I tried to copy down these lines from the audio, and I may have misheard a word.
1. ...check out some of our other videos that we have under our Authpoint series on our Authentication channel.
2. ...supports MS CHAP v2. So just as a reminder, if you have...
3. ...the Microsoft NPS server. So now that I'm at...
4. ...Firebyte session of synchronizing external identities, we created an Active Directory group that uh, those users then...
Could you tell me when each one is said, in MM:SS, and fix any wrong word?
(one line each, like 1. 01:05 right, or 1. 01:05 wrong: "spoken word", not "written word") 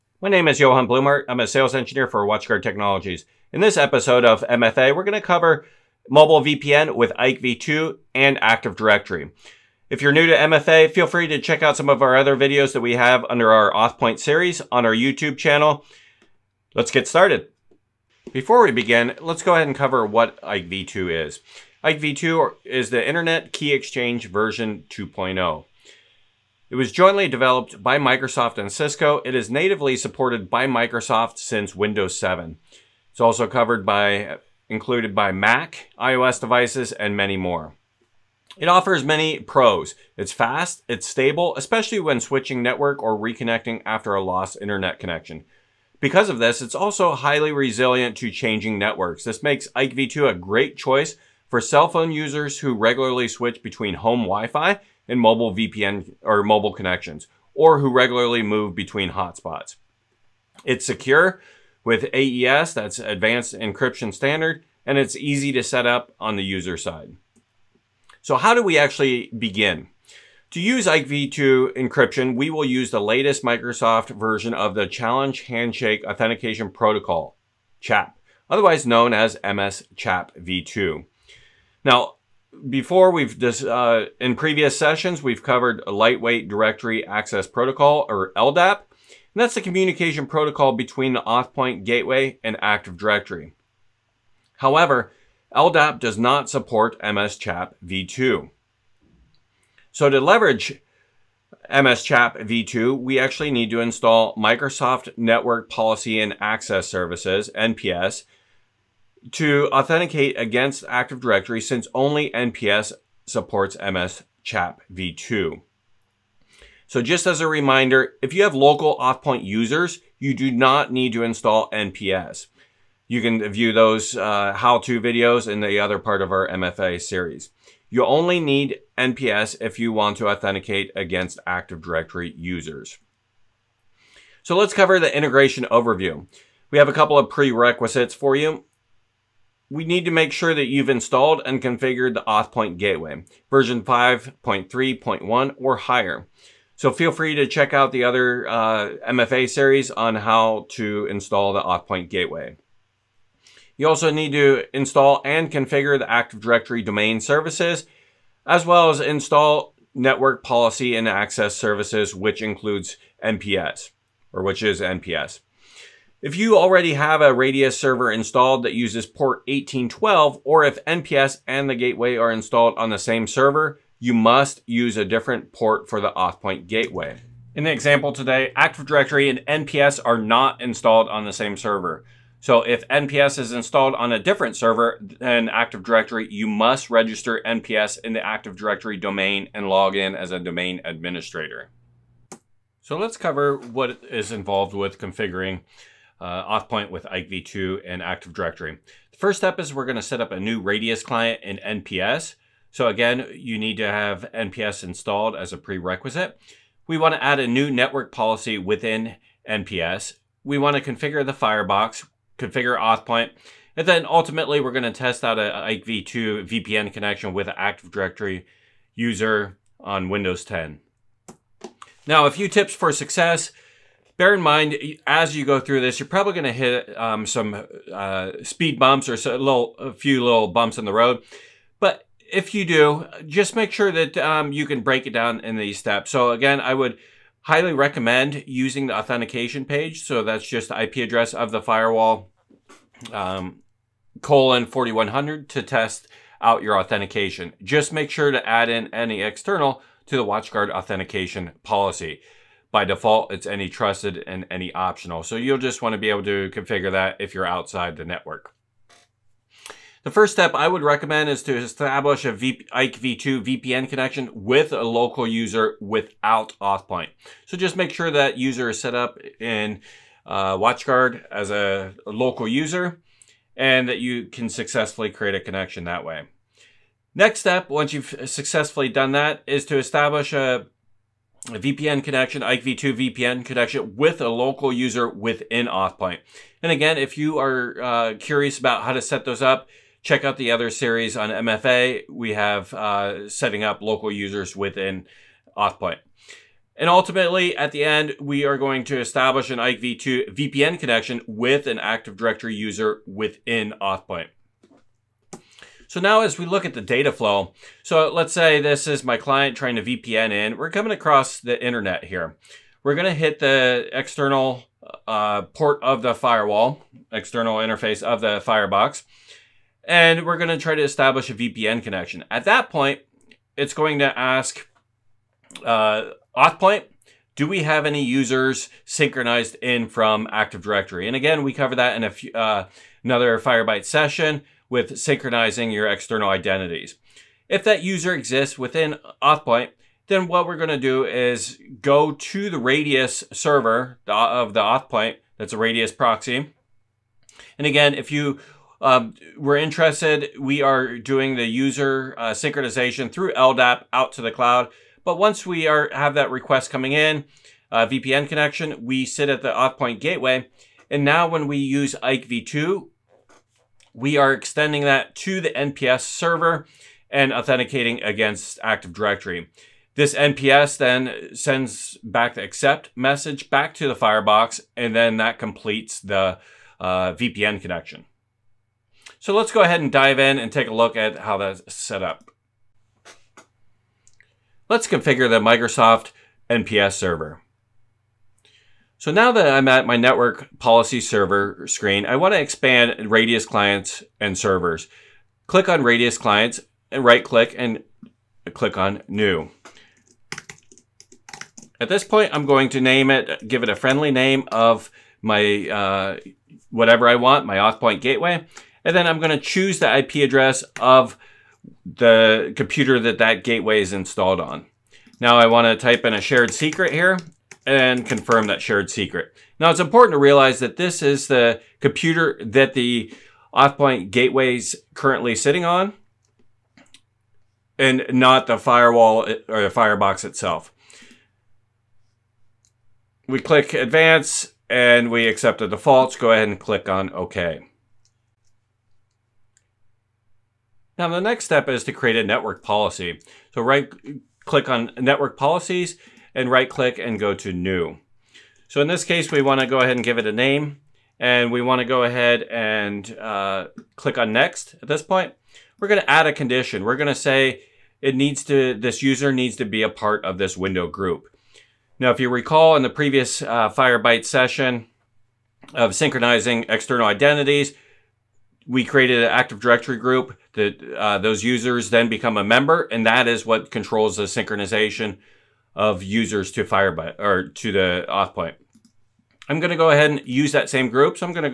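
1. 00:11 wrong: "YouTube", not "Authentication"
2. 01:53 right
3. 06:25 right
4. 07:43 right.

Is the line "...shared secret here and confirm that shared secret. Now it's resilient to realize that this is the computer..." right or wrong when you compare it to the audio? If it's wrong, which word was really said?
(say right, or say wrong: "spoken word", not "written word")
wrong: "important", not "resilient".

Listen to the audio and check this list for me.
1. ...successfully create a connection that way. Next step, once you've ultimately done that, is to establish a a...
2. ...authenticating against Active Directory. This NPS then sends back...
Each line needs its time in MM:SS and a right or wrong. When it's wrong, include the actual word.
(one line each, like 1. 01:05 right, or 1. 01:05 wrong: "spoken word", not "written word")
1. 04:34 wrong: "successfully", not "ultimately"
2. 06:07 right.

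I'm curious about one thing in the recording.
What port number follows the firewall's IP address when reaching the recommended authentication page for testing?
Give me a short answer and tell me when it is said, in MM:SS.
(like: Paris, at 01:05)
4100, at 04:04.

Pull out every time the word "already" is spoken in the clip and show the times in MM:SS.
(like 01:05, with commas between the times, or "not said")
02:46.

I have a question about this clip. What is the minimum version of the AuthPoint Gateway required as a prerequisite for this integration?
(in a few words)
5.3.1.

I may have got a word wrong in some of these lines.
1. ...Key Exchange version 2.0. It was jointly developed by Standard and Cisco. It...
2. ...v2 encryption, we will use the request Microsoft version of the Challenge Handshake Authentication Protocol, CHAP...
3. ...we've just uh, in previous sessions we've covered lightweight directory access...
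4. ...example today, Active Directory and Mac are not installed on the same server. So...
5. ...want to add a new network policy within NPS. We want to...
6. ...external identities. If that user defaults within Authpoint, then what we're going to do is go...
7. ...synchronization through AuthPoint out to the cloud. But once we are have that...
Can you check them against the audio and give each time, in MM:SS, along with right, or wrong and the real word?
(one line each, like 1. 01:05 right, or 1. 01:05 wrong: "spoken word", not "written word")
1. 00:23 wrong: "Microsoft", not "Standard"
2. 01:11 wrong: "latest", not "request"
3. 01:23 right
4. 02:57 wrong: "NPS", not "Mac"
5. 03:26 right
6. 05:35 wrong: "exists", not "defaults"
7. 05:52 wrong: "LDAP", not "AuthPoint".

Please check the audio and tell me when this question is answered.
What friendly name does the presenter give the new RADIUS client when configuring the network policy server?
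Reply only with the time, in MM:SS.
06:47.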